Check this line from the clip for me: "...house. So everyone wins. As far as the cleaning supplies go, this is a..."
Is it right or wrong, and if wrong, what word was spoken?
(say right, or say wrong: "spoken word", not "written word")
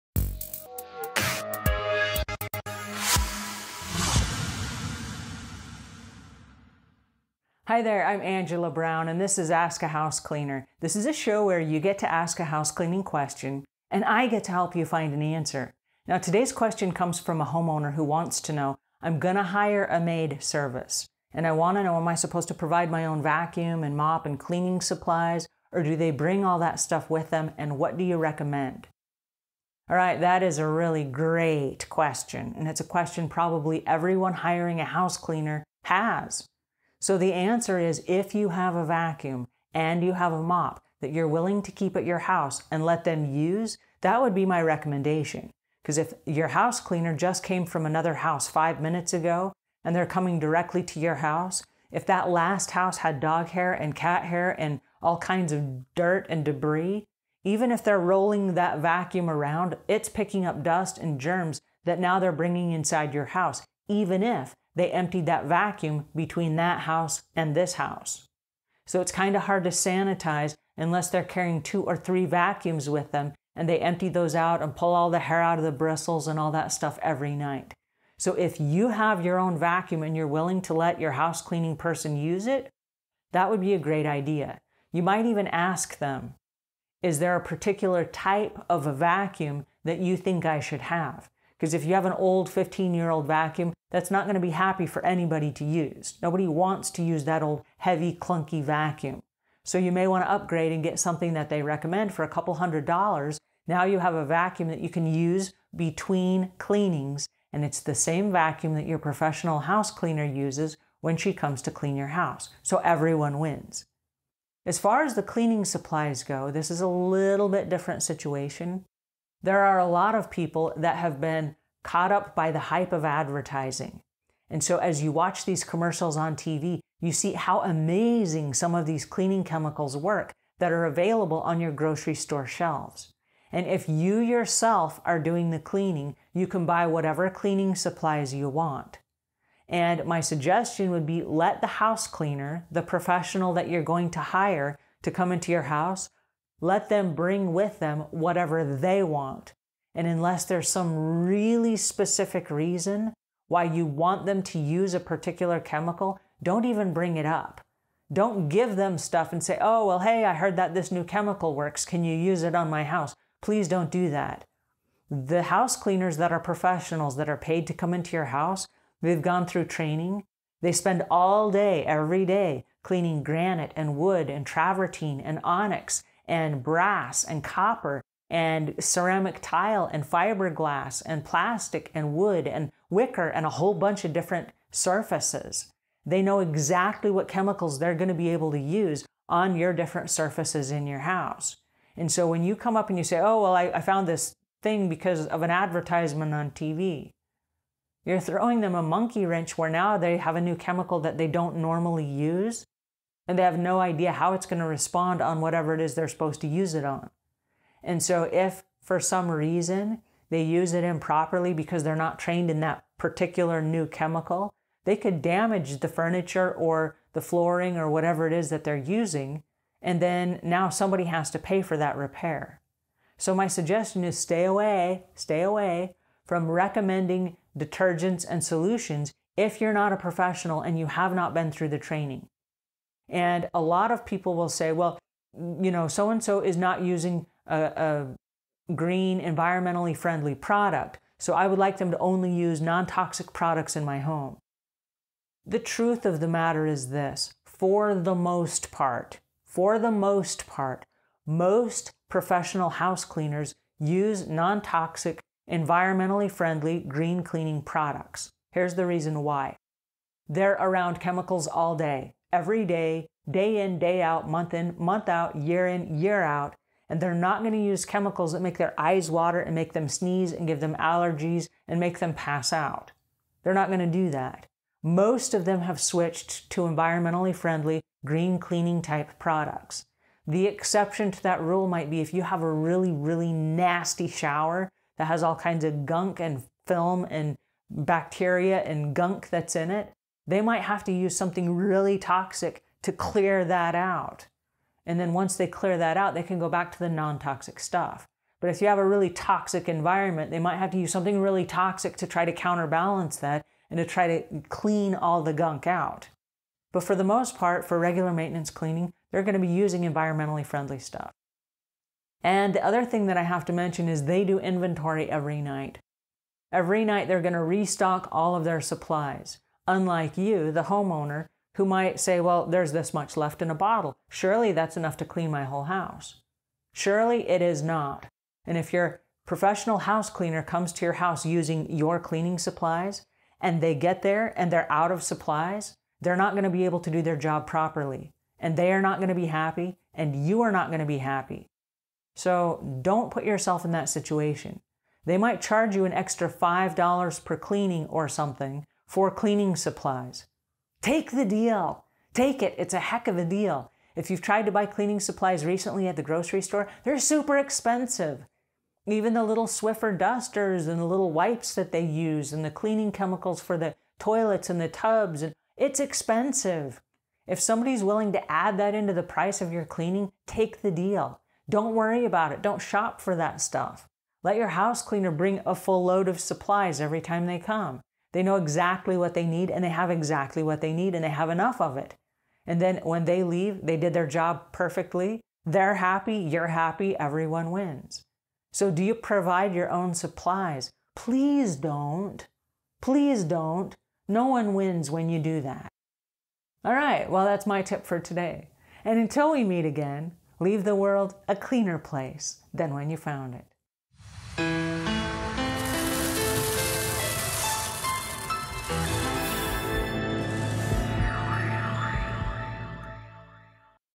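right.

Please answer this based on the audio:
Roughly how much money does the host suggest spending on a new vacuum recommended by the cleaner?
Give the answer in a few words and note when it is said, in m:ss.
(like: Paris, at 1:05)
a couple hundred dollars, at 1:42.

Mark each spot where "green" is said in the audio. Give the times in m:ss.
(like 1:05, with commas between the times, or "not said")
3:58, 4:16, 4:38.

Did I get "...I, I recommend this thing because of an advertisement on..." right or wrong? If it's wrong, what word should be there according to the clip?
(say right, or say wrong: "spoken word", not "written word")
wrong: "found", not "recommend".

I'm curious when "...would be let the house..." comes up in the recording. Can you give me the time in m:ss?
2:20.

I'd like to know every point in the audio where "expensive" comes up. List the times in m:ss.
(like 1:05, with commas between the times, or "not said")
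5:57, 6:05.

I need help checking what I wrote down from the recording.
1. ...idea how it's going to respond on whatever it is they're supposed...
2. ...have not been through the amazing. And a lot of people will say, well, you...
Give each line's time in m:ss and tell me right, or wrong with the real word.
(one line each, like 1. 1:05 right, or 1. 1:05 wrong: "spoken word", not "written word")
1. 3:23 right
2. 3:50 wrong: "training", not "amazing".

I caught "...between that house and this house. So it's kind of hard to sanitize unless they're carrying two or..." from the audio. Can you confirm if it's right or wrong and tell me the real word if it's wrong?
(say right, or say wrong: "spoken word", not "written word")
right.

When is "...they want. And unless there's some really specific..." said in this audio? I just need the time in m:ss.
2:28.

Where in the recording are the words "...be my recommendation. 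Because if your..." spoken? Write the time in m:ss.
0:44.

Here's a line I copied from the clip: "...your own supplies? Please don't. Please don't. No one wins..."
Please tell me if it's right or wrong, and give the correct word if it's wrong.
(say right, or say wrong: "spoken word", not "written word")
right.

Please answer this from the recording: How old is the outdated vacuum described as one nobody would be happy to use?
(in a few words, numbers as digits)
15 years.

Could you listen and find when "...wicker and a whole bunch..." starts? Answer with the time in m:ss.
3:02.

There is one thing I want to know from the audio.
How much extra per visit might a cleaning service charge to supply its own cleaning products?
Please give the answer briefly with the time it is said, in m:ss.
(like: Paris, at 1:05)
$5, at 5:46.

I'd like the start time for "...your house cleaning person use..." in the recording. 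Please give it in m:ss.
1:21.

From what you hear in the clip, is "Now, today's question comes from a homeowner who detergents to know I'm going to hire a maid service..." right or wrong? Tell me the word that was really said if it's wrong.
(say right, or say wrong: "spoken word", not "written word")
wrong: "wants", not "detergents".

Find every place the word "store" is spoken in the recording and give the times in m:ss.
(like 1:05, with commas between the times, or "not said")
2:12, 5:56.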